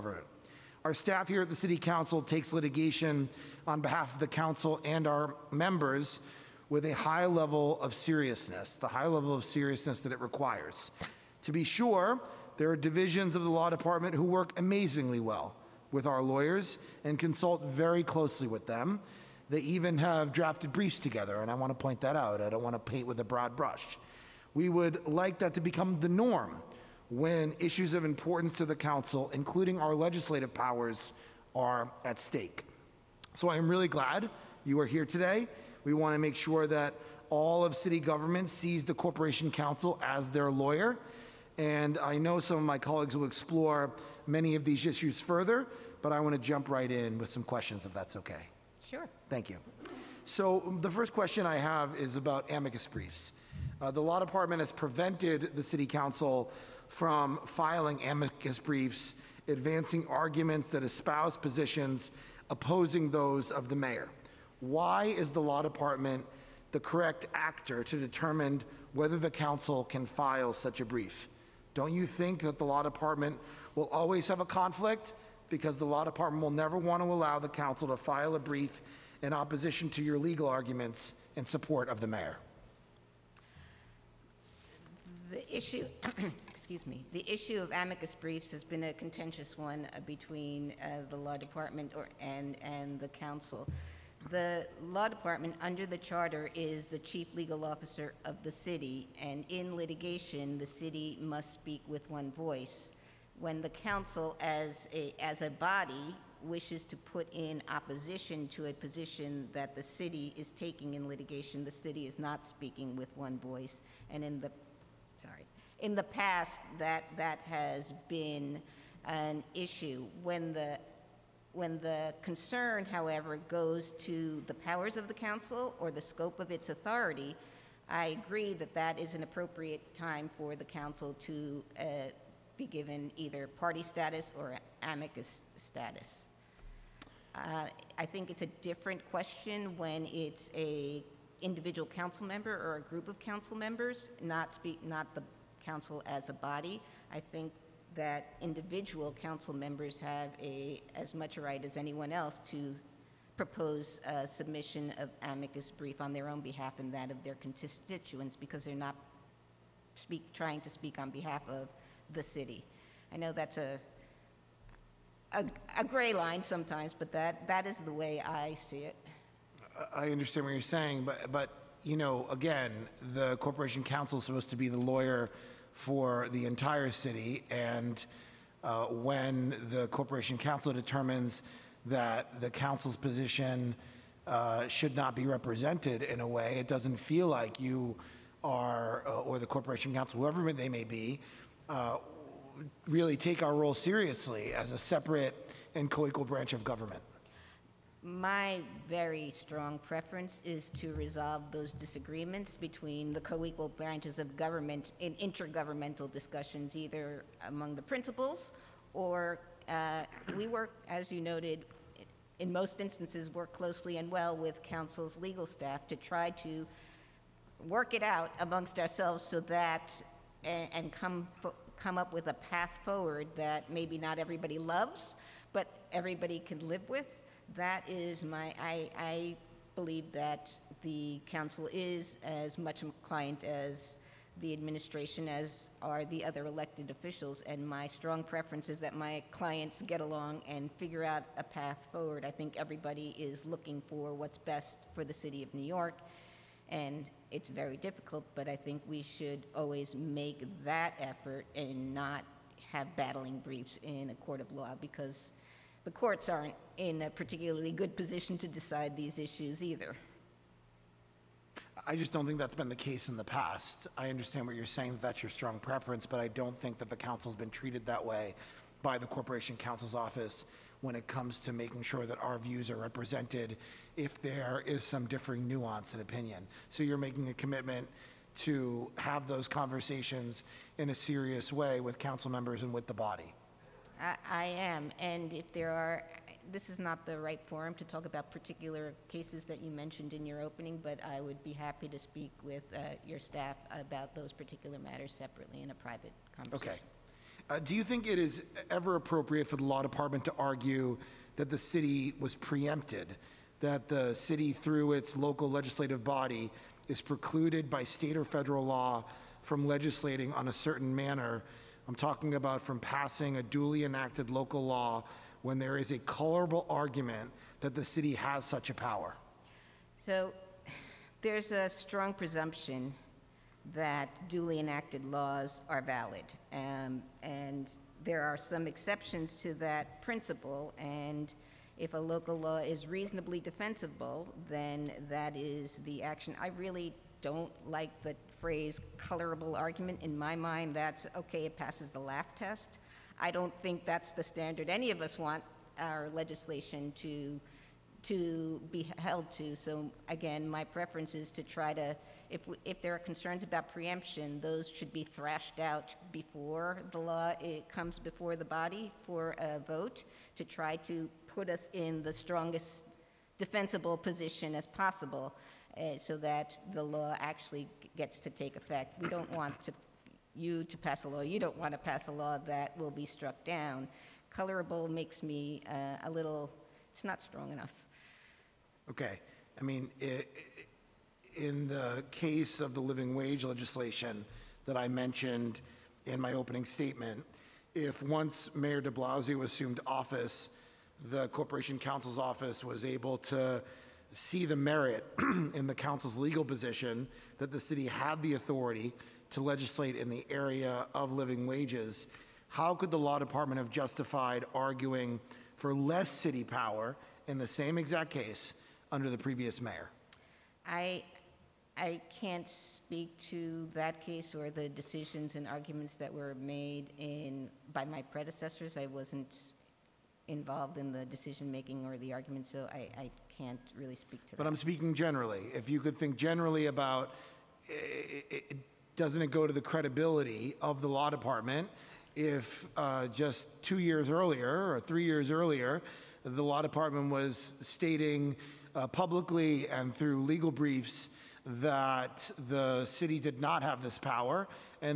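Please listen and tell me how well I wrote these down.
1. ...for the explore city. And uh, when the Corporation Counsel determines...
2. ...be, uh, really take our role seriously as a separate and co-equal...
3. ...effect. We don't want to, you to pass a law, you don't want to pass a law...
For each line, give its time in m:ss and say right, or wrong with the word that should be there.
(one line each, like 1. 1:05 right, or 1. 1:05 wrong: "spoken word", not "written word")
1. 2:55 wrong: "entire", not "explore"
2. 3:10 right
3. 6:08 right.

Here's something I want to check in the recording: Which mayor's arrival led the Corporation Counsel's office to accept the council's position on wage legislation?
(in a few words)
Mayor de Blasio.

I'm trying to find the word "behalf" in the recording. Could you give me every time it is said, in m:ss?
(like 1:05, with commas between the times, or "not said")
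0:03, 2:36, 2:41.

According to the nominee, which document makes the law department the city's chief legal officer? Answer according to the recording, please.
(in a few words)
the charter.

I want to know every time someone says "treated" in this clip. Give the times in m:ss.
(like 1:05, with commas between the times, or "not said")
4:27.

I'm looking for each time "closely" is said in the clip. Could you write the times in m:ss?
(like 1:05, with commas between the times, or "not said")
0:18, 3:33.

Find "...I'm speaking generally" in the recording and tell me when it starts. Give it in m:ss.
7:04.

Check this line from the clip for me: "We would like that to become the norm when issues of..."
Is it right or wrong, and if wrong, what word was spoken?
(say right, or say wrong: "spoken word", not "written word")
right.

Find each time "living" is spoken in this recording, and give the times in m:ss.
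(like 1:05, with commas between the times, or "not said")
6:22, 6:41.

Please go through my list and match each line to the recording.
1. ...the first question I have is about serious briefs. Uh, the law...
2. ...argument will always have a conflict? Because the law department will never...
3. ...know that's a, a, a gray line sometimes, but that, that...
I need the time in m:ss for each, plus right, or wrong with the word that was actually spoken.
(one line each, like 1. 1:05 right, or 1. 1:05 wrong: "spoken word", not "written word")
1. 0:50 wrong: "amicus", not "serious"
2. 1:12 wrong: "department", not "argument"
3. 2:43 right.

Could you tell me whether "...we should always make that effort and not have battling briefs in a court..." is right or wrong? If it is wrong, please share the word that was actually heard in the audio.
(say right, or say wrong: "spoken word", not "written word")
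right.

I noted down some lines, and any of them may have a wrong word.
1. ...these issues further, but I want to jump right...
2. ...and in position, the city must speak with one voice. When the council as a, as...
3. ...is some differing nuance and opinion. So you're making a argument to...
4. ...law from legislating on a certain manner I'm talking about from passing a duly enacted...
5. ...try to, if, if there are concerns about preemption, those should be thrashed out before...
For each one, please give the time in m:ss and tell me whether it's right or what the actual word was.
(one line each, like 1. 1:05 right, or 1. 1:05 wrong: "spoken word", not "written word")
1. 0:44 right
2. 1:39 wrong: "litigation", not "position"
3. 4:34 wrong: "commitment", not "argument"
4. 5:08 right
5. 5:51 right.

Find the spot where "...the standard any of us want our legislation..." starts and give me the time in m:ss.
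5:44.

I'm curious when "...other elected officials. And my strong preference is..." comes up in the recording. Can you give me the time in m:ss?
3:56.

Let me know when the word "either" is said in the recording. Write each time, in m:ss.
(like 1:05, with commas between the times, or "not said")
2:13, 3:26, 4:19.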